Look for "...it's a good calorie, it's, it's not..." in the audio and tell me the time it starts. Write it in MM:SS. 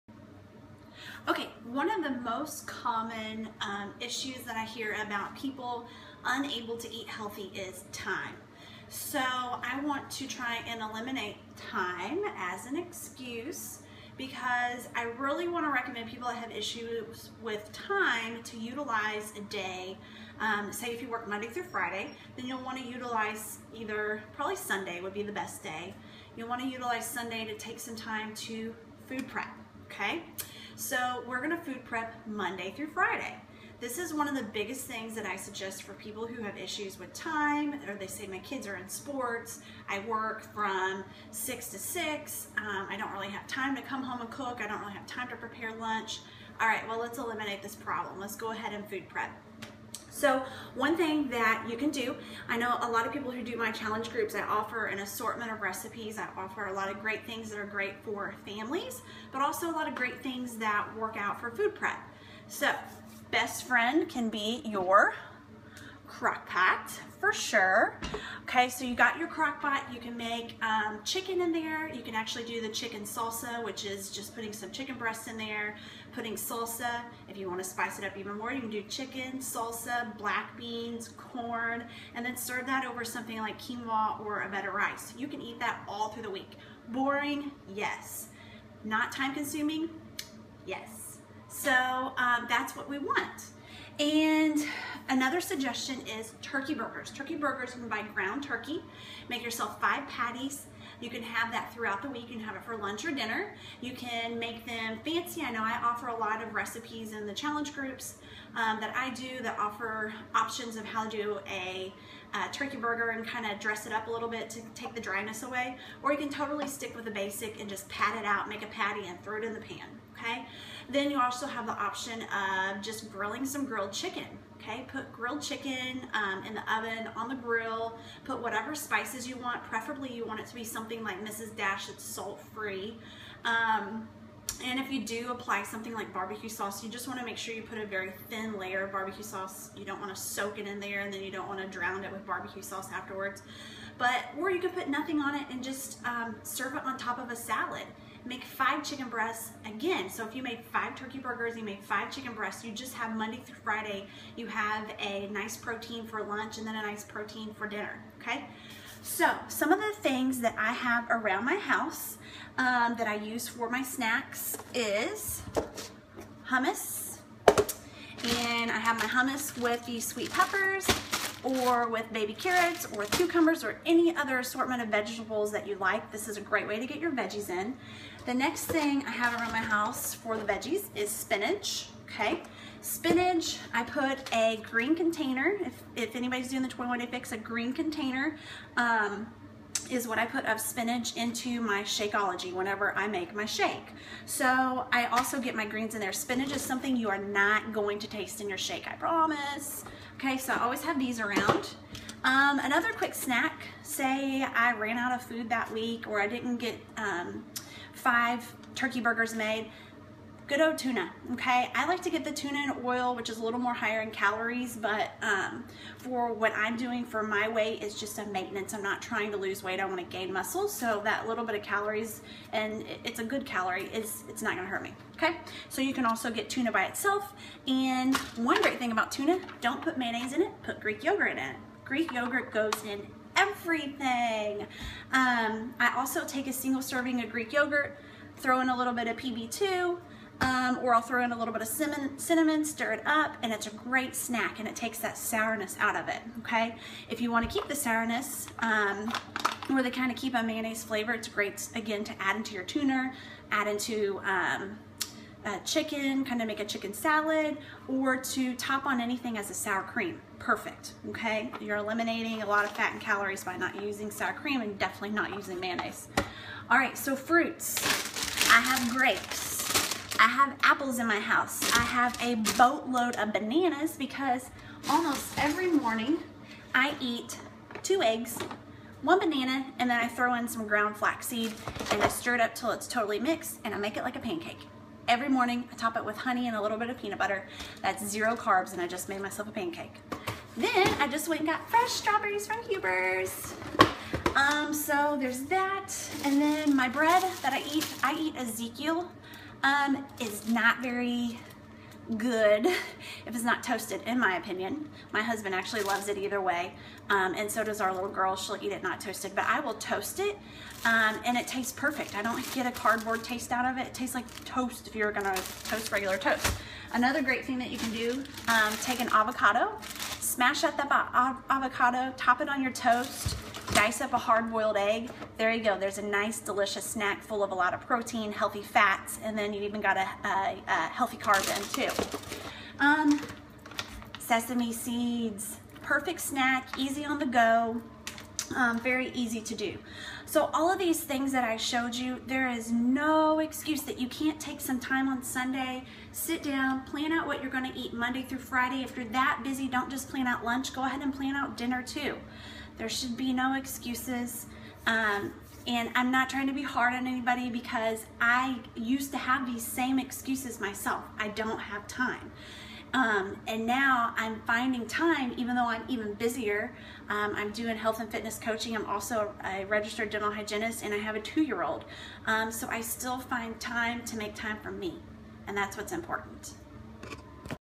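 03:43.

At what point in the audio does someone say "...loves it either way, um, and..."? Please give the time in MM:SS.
05:05.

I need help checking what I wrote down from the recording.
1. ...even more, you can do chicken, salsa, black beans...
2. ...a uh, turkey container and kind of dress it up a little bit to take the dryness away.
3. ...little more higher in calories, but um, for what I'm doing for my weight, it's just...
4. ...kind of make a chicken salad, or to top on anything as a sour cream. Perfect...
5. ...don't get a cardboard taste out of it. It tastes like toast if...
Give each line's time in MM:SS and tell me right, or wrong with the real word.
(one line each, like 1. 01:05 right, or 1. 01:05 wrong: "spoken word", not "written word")
1. 01:18 right
2. 01:51 wrong: "burger", not "container"
3. 03:33 right
4. 04:16 right
5. 05:12 right.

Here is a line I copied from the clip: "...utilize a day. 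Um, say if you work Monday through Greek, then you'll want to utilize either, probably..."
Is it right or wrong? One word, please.
wrong.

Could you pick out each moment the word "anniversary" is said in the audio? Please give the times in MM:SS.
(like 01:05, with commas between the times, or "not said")
not said.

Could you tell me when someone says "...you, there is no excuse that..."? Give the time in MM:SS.
05:41.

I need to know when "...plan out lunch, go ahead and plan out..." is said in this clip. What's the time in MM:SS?
05:50.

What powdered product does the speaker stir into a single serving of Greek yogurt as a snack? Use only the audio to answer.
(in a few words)
PB2.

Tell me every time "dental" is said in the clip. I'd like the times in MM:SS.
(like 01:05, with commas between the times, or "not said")
06:10.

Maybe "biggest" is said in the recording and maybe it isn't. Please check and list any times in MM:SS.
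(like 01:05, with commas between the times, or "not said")
00:34.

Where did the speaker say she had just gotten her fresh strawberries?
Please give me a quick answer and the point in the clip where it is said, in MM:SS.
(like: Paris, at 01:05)
Huber's, at 04:52.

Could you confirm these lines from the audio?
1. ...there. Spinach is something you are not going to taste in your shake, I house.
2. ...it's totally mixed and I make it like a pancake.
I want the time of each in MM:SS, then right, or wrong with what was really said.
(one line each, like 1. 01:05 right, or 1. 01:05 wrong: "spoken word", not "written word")
1. 03:16 wrong: "promise", not "house"
2. 04:42 right.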